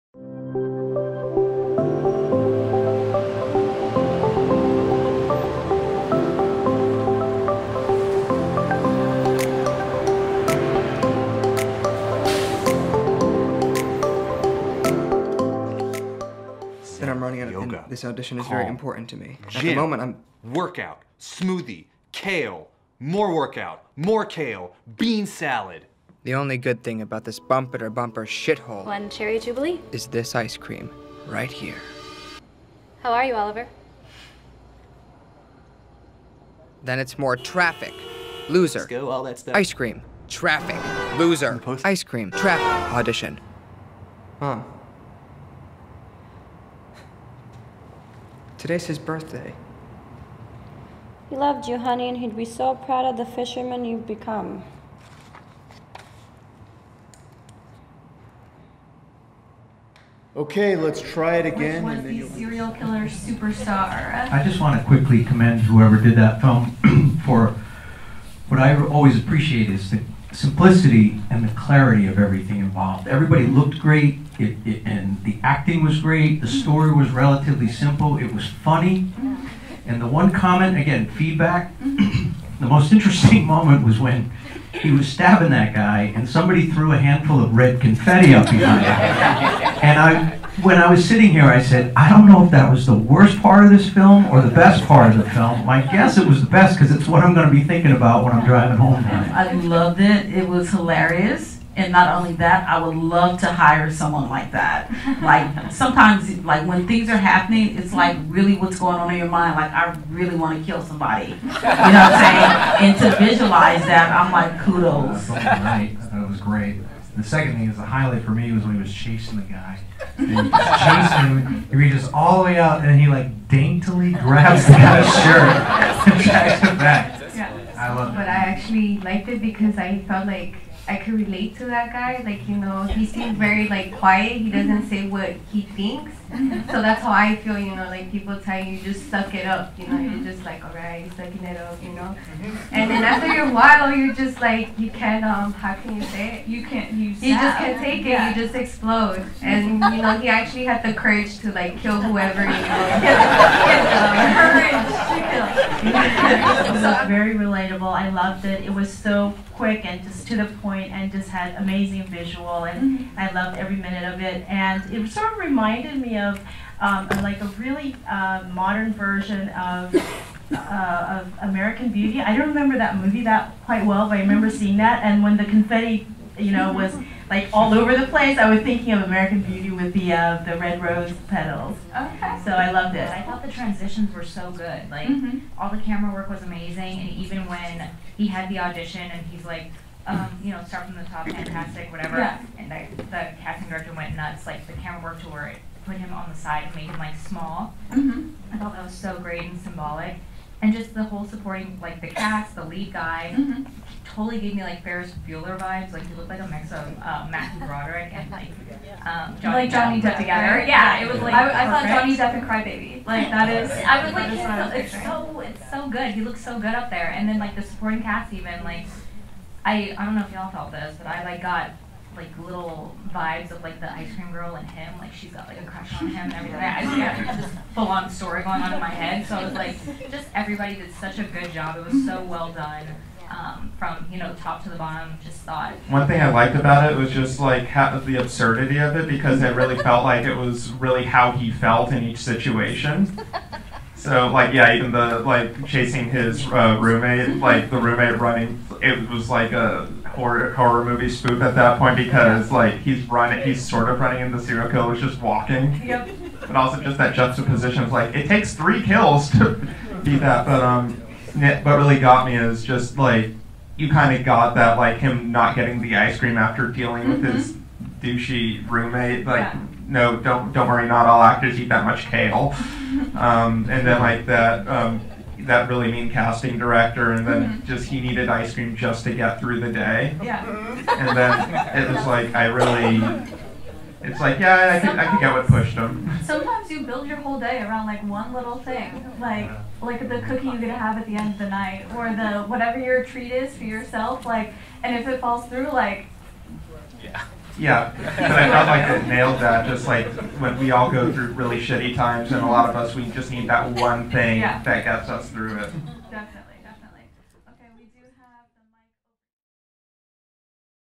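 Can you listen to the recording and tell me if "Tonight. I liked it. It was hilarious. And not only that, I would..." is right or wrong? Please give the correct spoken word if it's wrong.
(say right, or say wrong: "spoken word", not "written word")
wrong: "loved", not "liked".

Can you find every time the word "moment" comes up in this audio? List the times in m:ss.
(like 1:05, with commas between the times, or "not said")
0:19, 1:23.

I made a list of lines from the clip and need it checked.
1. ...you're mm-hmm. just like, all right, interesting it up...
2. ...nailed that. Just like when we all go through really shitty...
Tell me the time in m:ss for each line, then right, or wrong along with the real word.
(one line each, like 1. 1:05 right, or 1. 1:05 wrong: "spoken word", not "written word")
1. 2:19 wrong: "sucking", not "interesting"
2. 4:59 right.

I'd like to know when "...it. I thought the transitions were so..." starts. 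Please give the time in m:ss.
3:02.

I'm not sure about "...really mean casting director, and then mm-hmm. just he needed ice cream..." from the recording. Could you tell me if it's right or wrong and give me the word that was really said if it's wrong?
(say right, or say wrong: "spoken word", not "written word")
right.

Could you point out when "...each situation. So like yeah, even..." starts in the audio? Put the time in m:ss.
4:02.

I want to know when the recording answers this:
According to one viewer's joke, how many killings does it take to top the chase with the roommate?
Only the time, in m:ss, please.
4:18.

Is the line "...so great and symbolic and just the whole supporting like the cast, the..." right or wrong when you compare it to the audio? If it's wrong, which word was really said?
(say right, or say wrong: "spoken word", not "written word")
right.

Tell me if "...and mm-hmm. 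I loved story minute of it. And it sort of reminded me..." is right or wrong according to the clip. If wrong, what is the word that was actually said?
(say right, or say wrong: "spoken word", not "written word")
wrong: "every", not "story".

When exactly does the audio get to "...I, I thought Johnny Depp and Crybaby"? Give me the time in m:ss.
3:31.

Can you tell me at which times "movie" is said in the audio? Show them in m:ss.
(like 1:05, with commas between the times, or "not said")
2:52, 4:10.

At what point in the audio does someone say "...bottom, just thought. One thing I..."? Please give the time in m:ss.
3:54.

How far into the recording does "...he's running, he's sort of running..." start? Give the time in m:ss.
4:12.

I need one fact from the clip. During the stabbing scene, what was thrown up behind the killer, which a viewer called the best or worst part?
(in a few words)
Red confetti.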